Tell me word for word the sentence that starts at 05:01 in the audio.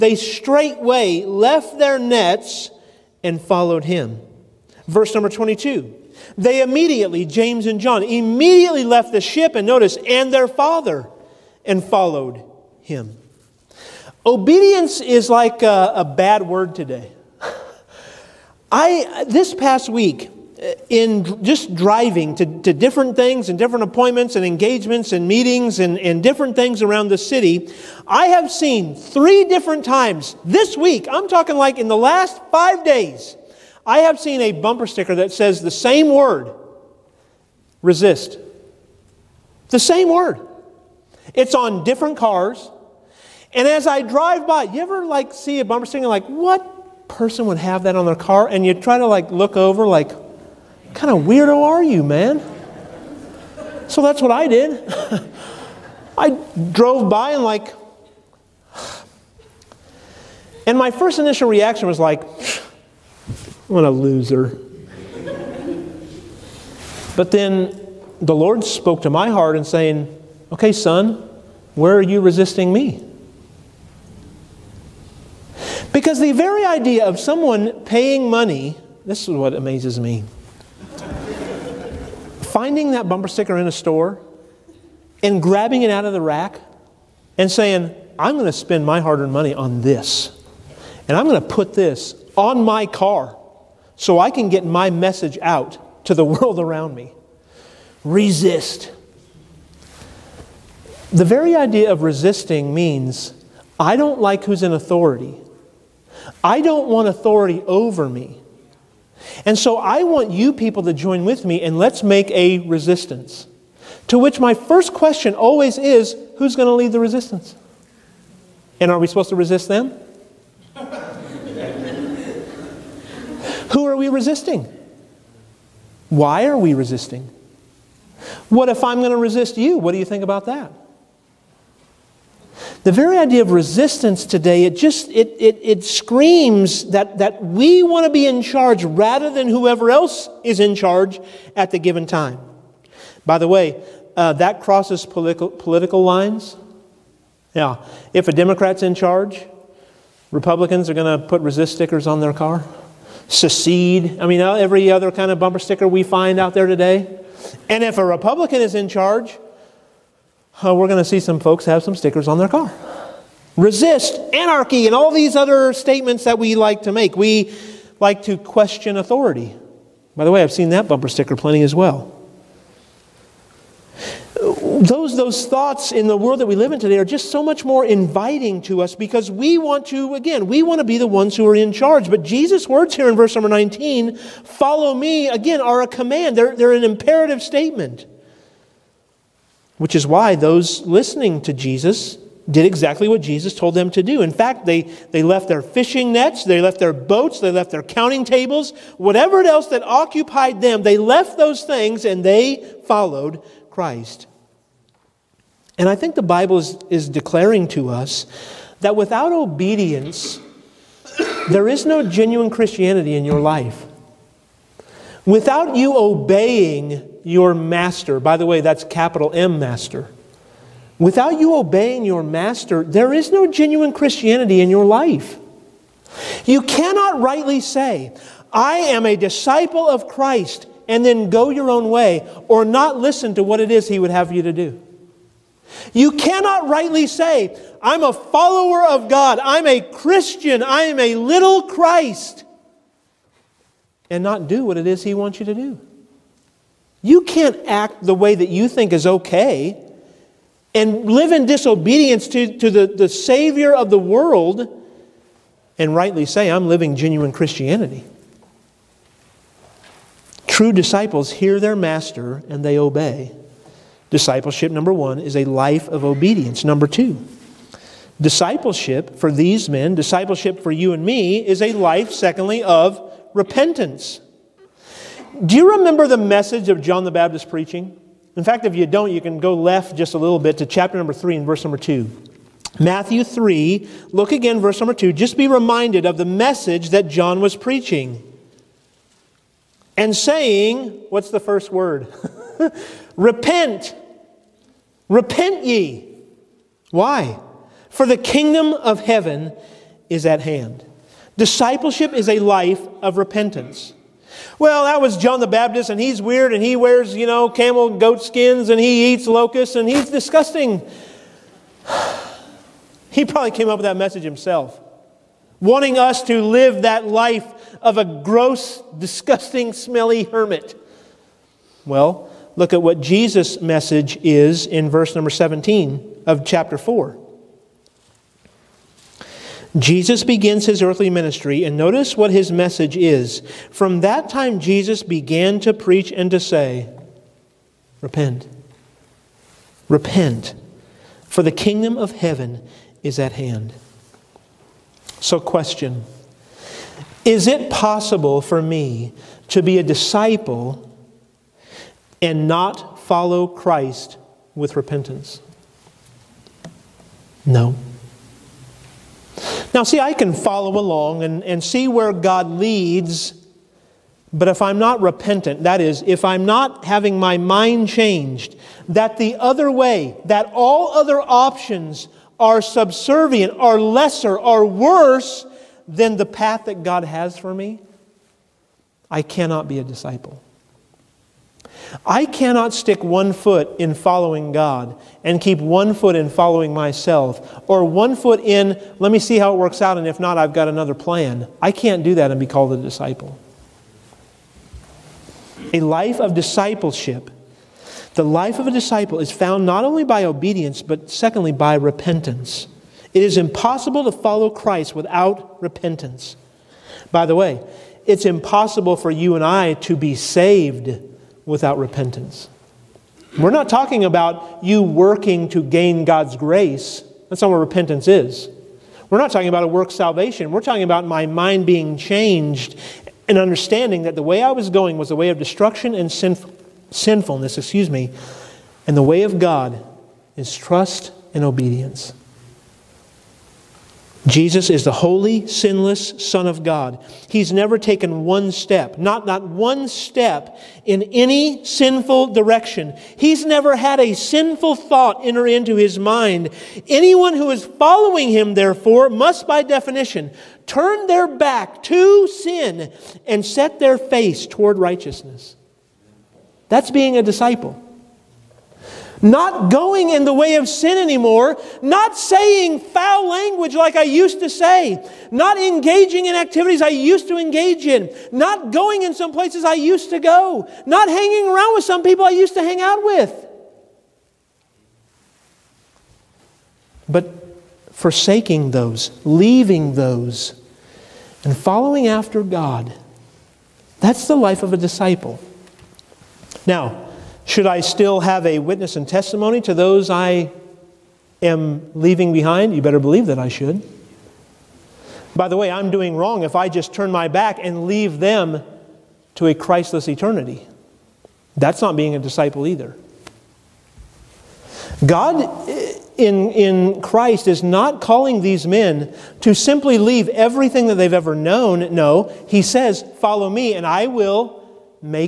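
Discipleship is a life of repentance.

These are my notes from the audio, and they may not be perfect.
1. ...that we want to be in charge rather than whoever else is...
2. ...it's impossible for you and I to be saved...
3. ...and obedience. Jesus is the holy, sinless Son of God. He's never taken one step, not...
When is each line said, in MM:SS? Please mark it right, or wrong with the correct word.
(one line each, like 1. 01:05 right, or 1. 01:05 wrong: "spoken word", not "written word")
1. 02:17 right
2. 06:48 right
3. 07:11 right.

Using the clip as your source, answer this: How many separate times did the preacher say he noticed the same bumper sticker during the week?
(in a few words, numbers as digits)
3.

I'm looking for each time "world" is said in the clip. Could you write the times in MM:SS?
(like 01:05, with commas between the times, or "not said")
01:36, 02:56, 04:13.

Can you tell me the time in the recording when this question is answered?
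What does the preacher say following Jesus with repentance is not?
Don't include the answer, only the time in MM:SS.
06:59.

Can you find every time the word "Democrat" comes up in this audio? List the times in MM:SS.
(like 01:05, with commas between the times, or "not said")
02:28.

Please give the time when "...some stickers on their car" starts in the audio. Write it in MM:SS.
02:41.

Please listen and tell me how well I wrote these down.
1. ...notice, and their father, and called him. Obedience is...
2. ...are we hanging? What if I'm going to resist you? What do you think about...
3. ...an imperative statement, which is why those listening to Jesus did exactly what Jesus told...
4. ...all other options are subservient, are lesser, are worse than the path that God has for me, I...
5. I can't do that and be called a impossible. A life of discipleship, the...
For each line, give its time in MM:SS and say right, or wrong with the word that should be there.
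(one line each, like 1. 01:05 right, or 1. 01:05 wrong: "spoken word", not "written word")
1. 00:09 wrong: "followed", not "called"
2. 02:06 wrong: "resisting", not "hanging"
3. 03:06 right
4. 06:10 right
5. 06:31 wrong: "disciple", not "impossible".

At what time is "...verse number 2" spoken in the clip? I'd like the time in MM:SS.
04:44.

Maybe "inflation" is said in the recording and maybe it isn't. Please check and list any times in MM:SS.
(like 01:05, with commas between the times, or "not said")
not said.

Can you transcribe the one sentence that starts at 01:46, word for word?
I don't want authority over me.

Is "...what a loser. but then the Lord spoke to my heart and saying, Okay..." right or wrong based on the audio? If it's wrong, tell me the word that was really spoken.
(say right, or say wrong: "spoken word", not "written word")
right.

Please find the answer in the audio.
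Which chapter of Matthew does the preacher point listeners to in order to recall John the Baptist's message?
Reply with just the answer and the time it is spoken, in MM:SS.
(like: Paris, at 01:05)
Chapter 3, at 04:40.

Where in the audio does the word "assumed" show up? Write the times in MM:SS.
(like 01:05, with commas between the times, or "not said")
not said.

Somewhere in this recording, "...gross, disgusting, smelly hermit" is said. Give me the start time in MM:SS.
05:18.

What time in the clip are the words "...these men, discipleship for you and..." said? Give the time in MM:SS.
04:29.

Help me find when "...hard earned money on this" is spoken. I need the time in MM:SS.
01:29.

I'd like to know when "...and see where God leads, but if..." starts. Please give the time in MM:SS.
06:01.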